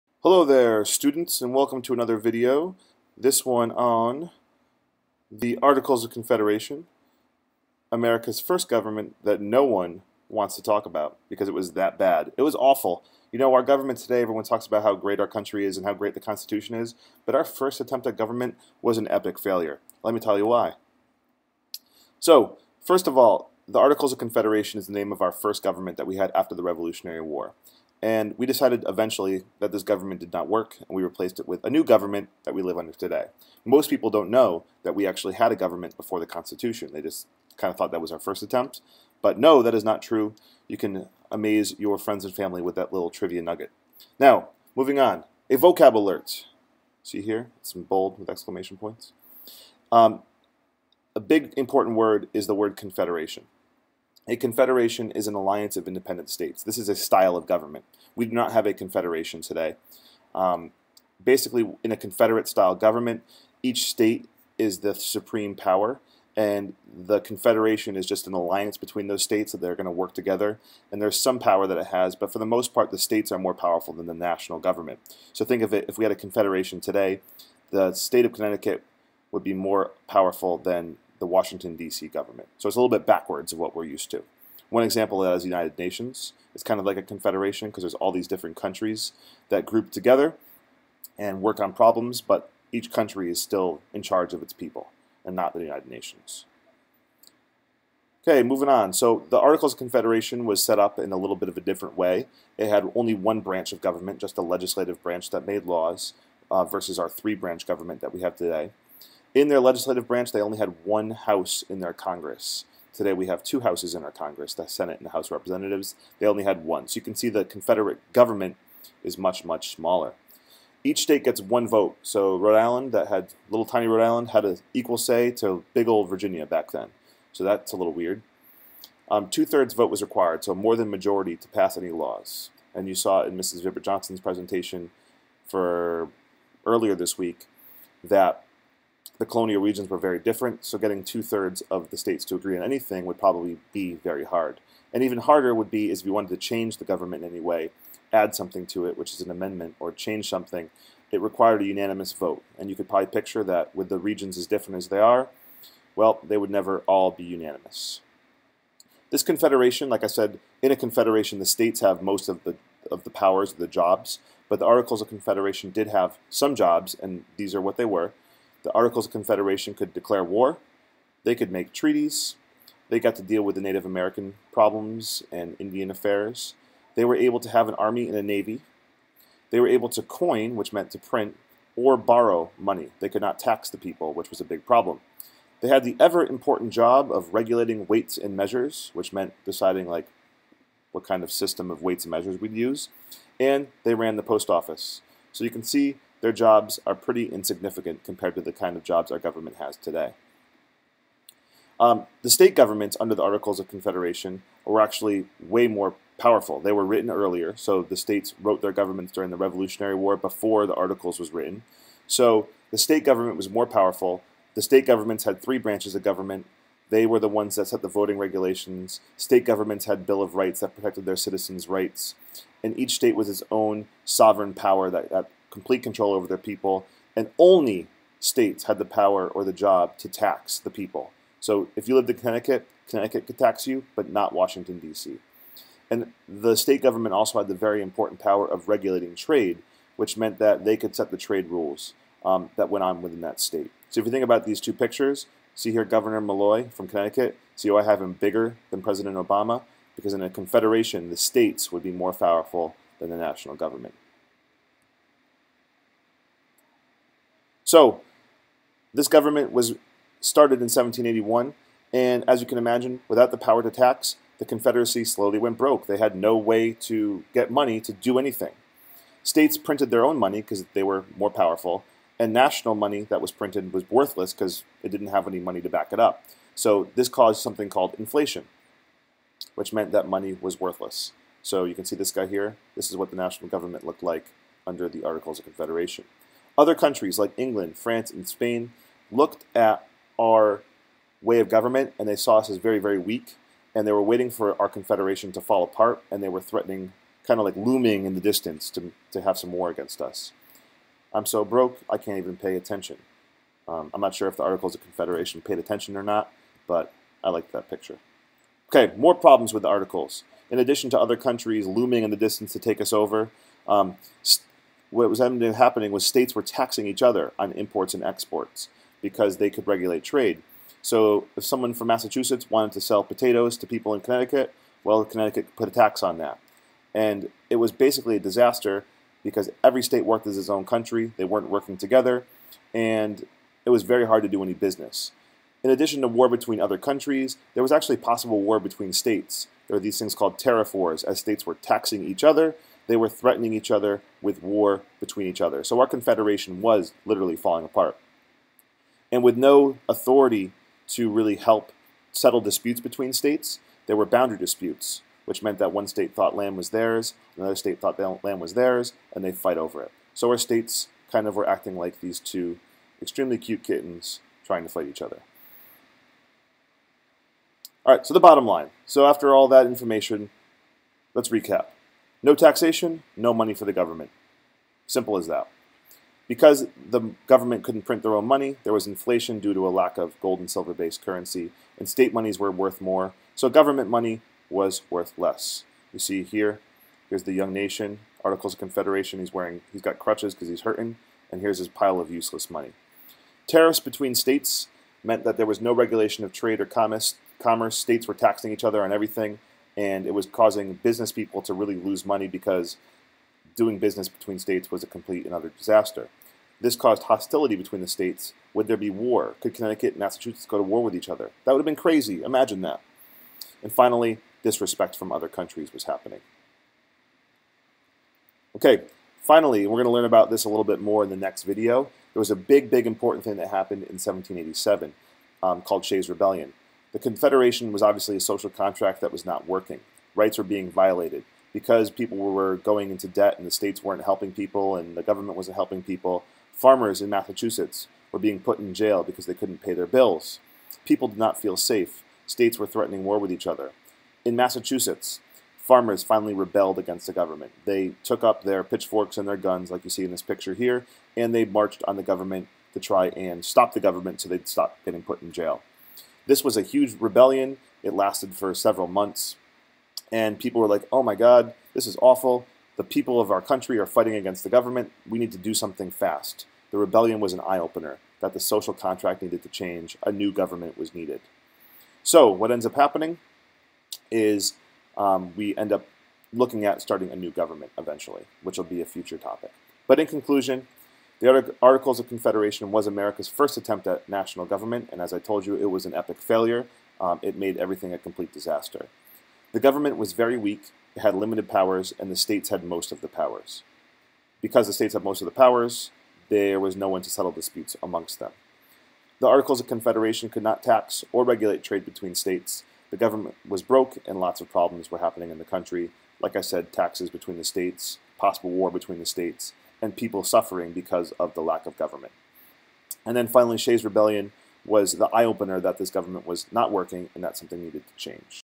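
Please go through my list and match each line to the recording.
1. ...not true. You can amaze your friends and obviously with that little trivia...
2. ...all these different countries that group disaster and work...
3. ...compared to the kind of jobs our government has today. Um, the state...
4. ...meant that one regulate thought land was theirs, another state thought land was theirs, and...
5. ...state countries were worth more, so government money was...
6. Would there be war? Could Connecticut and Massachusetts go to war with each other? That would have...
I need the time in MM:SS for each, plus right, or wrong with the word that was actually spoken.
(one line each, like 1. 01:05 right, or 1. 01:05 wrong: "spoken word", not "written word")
1. 00:39 wrong: "family", not "obviously"
2. 01:27 wrong: "together", not "disaster"
3. 03:18 right
4. 05:55 wrong: "state", not "regulate"
5. 06:21 wrong: "monies", not "countries"
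6. 06:48 right.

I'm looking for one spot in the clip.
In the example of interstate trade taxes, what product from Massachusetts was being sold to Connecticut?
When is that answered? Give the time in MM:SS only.
05:23.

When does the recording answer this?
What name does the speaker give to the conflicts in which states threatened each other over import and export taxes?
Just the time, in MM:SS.
05:40.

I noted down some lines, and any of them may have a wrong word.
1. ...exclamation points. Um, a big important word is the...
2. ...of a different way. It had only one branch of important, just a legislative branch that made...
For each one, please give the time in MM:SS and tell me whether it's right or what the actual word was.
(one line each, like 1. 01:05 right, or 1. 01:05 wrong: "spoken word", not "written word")
1. 00:48 right
2. 01:41 wrong: "government", not "important".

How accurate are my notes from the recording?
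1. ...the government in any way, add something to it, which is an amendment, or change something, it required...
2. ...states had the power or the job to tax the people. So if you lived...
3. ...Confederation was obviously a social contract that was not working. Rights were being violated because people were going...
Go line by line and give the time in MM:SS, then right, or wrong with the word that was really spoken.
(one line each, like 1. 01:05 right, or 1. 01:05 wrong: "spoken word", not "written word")
1. 02:26 right
2. 03:48 right
3. 07:06 right.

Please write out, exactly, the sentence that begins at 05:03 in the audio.
Um, I'm not sure if the Articles of Confederation paid attention or not, but I like that picture.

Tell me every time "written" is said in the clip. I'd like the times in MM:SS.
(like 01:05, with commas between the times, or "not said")
03:26, 03:31.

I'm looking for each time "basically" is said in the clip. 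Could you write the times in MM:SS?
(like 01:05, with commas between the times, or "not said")
01:01, 05:27.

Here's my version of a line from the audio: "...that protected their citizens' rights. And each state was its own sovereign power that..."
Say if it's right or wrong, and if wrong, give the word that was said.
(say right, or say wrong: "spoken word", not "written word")
right.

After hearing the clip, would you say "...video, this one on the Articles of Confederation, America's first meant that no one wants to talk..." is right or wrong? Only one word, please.
wrong.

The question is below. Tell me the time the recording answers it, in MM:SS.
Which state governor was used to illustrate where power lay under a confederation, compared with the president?
04:05.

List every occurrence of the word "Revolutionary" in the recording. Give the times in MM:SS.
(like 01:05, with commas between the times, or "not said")
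00:26, 03:29.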